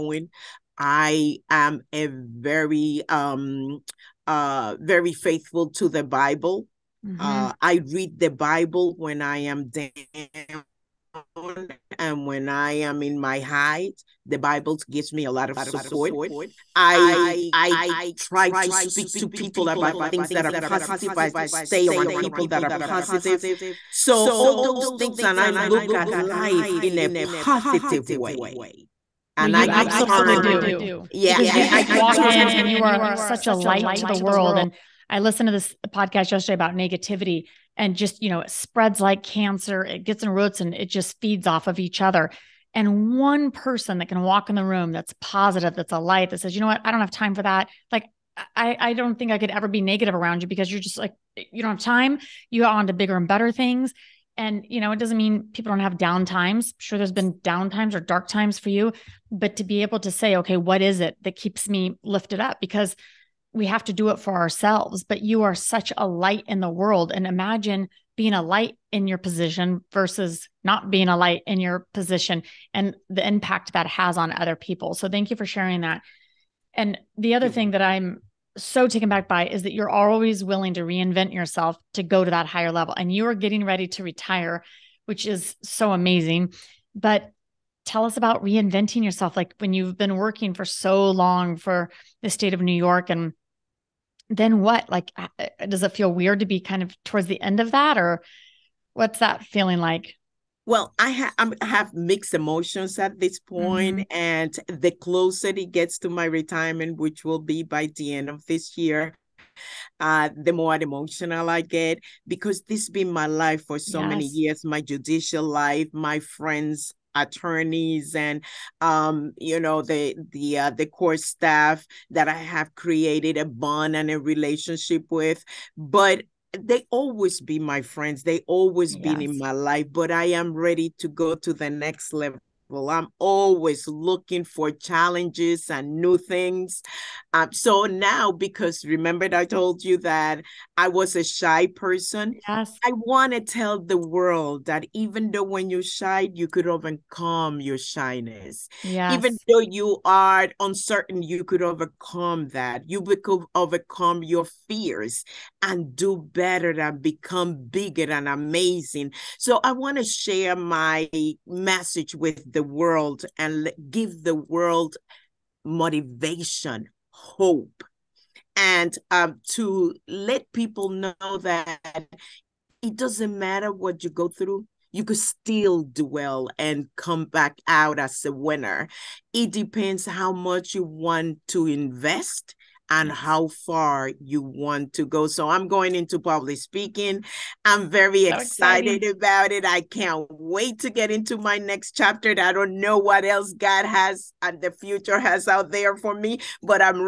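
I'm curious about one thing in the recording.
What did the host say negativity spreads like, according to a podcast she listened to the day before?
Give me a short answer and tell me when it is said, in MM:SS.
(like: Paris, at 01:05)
Cancer, at 00:39.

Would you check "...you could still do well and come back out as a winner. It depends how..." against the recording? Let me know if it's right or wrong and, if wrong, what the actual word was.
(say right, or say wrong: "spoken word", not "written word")
right.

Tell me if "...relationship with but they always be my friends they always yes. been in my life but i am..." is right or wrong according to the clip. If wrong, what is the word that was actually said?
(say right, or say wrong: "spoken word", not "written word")
right.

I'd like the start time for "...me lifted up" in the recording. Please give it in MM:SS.
01:01.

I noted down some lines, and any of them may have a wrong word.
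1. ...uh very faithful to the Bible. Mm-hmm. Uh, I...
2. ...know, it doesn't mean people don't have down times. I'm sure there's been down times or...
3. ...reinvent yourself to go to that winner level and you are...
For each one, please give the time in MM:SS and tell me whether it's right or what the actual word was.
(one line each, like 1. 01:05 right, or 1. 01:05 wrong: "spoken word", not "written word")
1. 00:04 right
2. 00:54 right
3. 01:20 wrong: "higher", not "winner".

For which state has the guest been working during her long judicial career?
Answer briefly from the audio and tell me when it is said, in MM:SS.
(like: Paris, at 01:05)
New York, at 01:32.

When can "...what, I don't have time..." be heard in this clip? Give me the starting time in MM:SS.
00:46.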